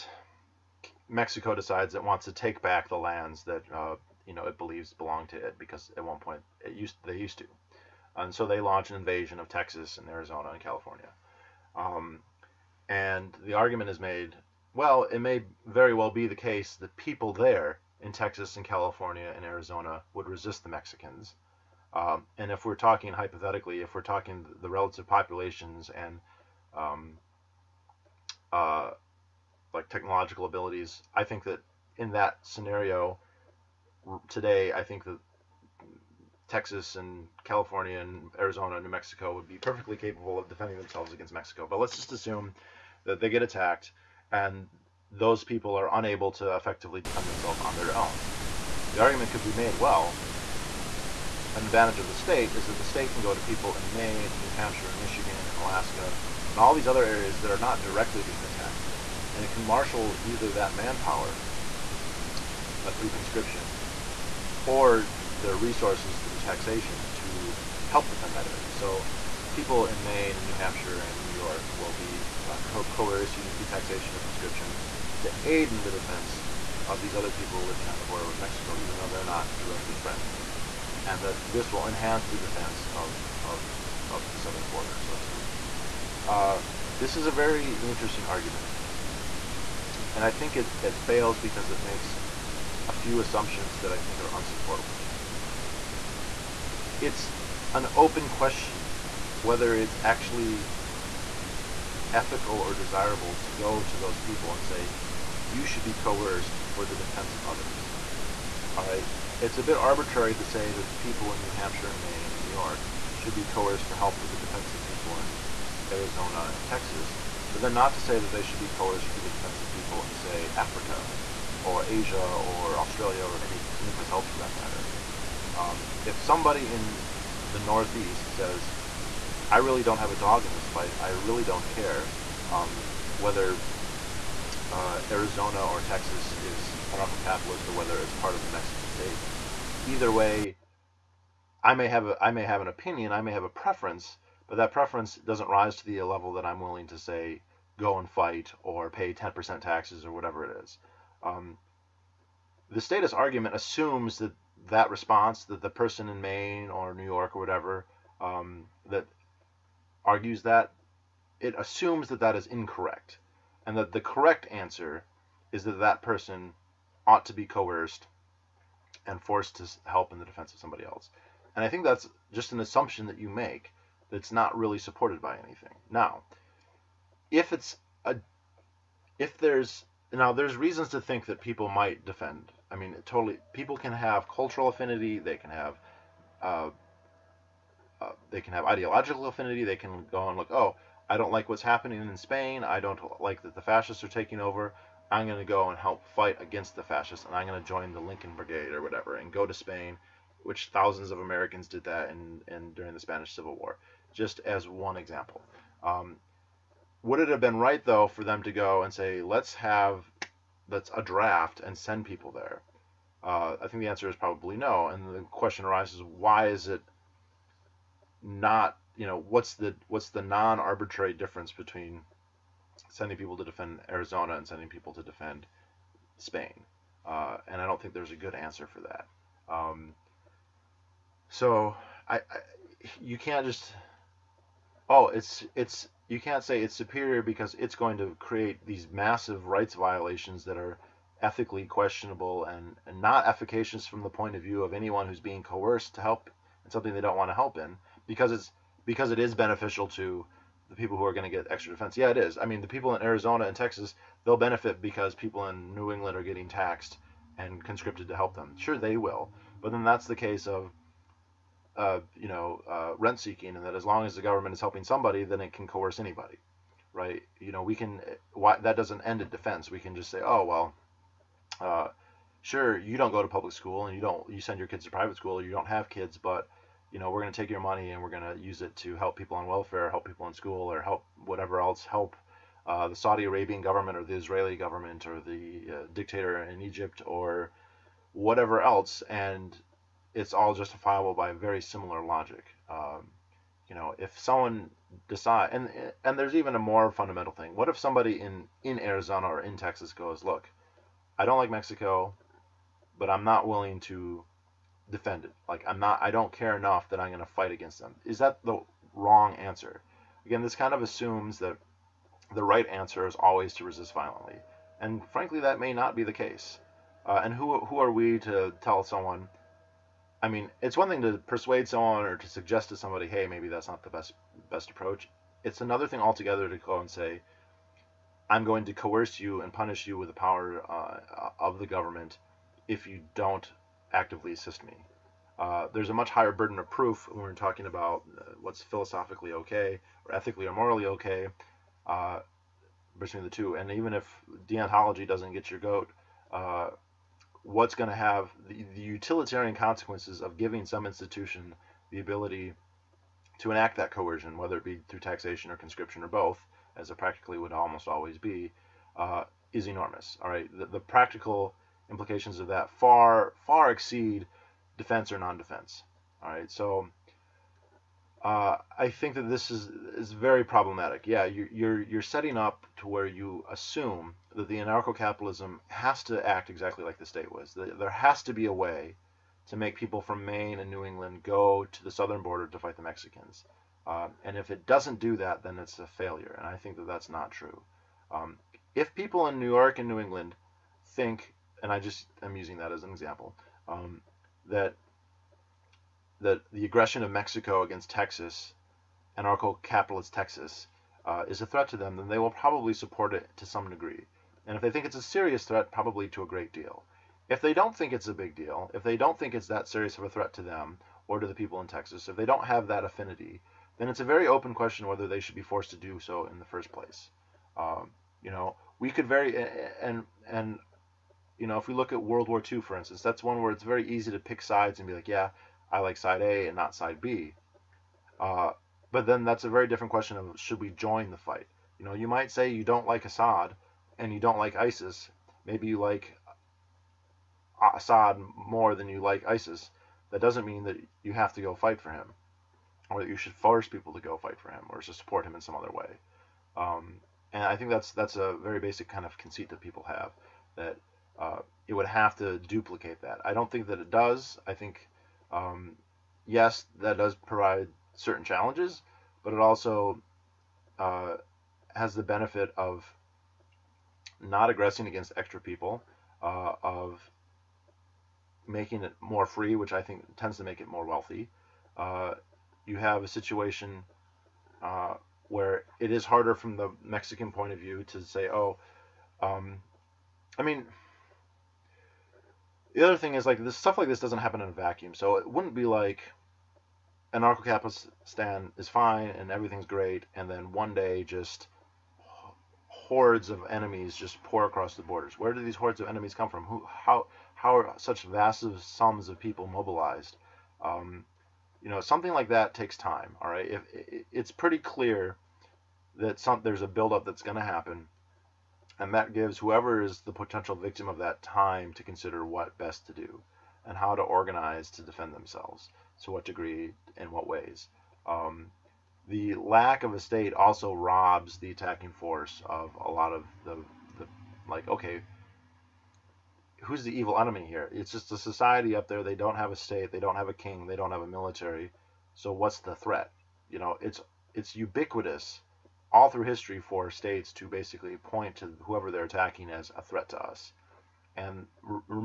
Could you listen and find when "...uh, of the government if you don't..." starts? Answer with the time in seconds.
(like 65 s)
330 s.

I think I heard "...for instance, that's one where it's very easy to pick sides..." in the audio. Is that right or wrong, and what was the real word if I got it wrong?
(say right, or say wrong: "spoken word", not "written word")
right.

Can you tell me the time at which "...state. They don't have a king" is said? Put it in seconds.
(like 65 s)
529 s.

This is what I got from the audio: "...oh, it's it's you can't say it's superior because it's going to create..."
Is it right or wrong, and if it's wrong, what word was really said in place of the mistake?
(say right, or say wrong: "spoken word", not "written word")
right.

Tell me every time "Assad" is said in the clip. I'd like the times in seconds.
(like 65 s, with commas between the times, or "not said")
433 s, 437 s.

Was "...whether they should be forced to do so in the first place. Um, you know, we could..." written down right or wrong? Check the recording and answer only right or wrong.
right.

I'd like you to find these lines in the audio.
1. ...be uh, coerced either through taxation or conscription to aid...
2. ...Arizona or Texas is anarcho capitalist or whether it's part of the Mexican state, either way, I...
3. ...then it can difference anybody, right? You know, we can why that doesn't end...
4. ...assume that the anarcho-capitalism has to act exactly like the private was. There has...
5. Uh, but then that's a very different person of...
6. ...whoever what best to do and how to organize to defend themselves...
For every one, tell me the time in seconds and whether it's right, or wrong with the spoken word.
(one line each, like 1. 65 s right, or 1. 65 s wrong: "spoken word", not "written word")
1. 71 s right
2. 135 s right
3. 265 s wrong: "coerce", not "difference"
4. 373 s wrong: "state", not "private"
5. 428 s wrong: "question", not "person"
6. 511 s wrong: "consider", not "whoever".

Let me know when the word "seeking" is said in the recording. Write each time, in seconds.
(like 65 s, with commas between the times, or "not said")
263 s.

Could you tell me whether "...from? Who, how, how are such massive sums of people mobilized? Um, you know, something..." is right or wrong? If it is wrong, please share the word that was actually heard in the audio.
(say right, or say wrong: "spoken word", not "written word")
right.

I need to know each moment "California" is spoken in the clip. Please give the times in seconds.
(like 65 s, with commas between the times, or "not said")
10 s, 18 s, 37 s.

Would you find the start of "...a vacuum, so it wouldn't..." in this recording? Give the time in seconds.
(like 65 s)
484 s.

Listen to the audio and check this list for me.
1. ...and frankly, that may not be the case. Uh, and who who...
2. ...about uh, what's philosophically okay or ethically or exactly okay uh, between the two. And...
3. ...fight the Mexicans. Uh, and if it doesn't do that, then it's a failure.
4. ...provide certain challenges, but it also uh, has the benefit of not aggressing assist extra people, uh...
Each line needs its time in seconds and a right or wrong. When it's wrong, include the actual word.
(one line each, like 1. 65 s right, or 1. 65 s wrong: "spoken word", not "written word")
1. 314 s right
2. 337 s wrong: "morally", not "exactly"
3. 382 s right
4. 457 s wrong: "against", not "assist".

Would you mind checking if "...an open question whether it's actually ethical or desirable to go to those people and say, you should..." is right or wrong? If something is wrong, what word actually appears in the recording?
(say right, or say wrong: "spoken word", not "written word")
right.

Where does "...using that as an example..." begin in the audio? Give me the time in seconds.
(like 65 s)
392 s.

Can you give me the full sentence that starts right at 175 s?
Now, if it's a if there's now there's reasons to think that people might defend.